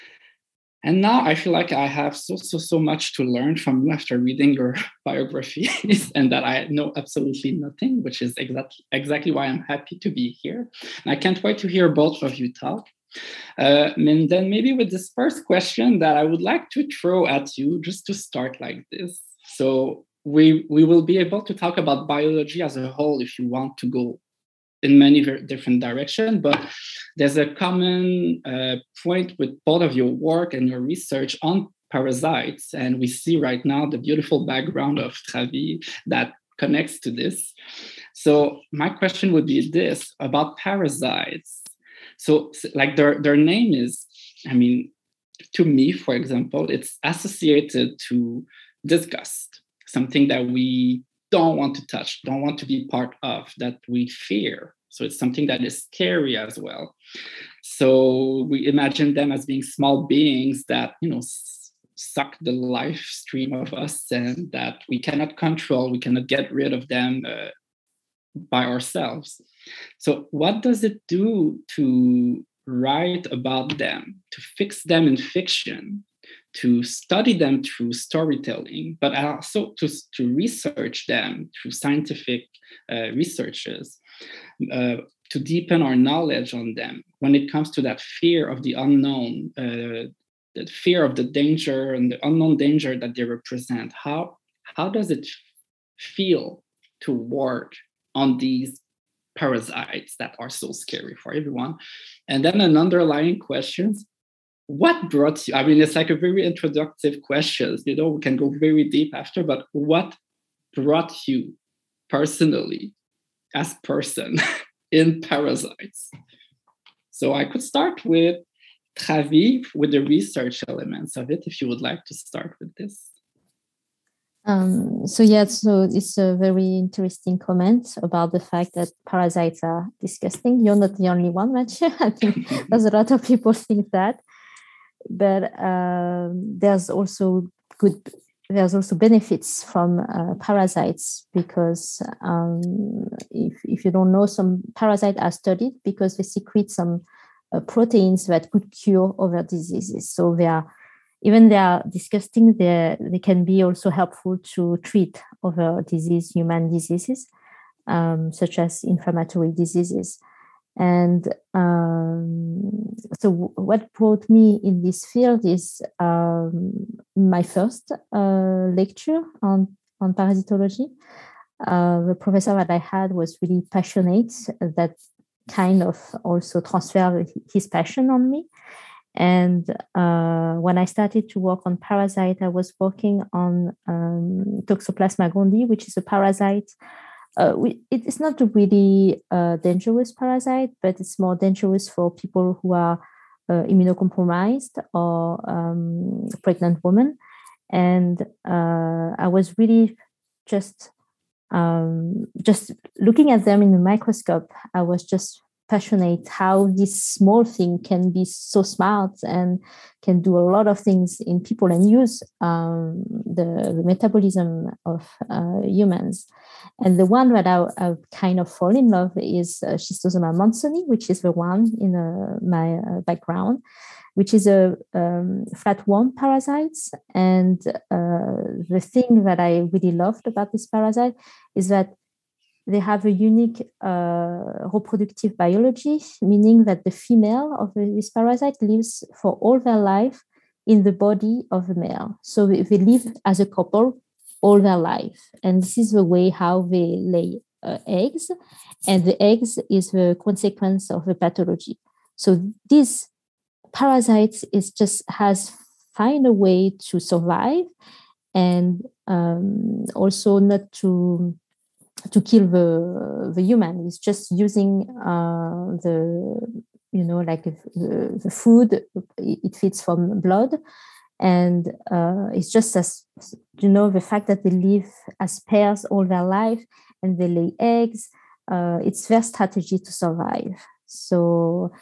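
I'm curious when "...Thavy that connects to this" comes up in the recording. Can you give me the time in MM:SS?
00:35.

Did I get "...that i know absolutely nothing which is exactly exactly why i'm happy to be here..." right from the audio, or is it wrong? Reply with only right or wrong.
right.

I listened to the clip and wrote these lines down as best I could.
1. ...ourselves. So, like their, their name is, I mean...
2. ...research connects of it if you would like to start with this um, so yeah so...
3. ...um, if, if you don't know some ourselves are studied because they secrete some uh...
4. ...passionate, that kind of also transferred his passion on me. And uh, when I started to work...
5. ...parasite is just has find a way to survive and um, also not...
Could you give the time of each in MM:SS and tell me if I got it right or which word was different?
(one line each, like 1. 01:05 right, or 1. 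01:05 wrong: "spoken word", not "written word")
1. 00:40 wrong: "parasites", not "ourselves"
2. 01:59 wrong: "elements", not "connects"
3. 02:22 wrong: "parasites", not "ourselves"
4. 02:53 right
5. 04:13 right.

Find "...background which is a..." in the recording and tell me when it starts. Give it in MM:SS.
03:43.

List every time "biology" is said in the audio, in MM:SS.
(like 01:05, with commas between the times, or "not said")
00:22, 03:55.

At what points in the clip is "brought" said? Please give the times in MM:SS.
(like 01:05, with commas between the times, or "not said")
01:45, 01:50, 02:43.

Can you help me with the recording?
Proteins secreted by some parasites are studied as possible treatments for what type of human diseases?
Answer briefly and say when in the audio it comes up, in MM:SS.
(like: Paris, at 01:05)
Inflammatory diseases, at 02:38.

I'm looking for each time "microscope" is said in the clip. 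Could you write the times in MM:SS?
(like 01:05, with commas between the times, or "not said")
03:23.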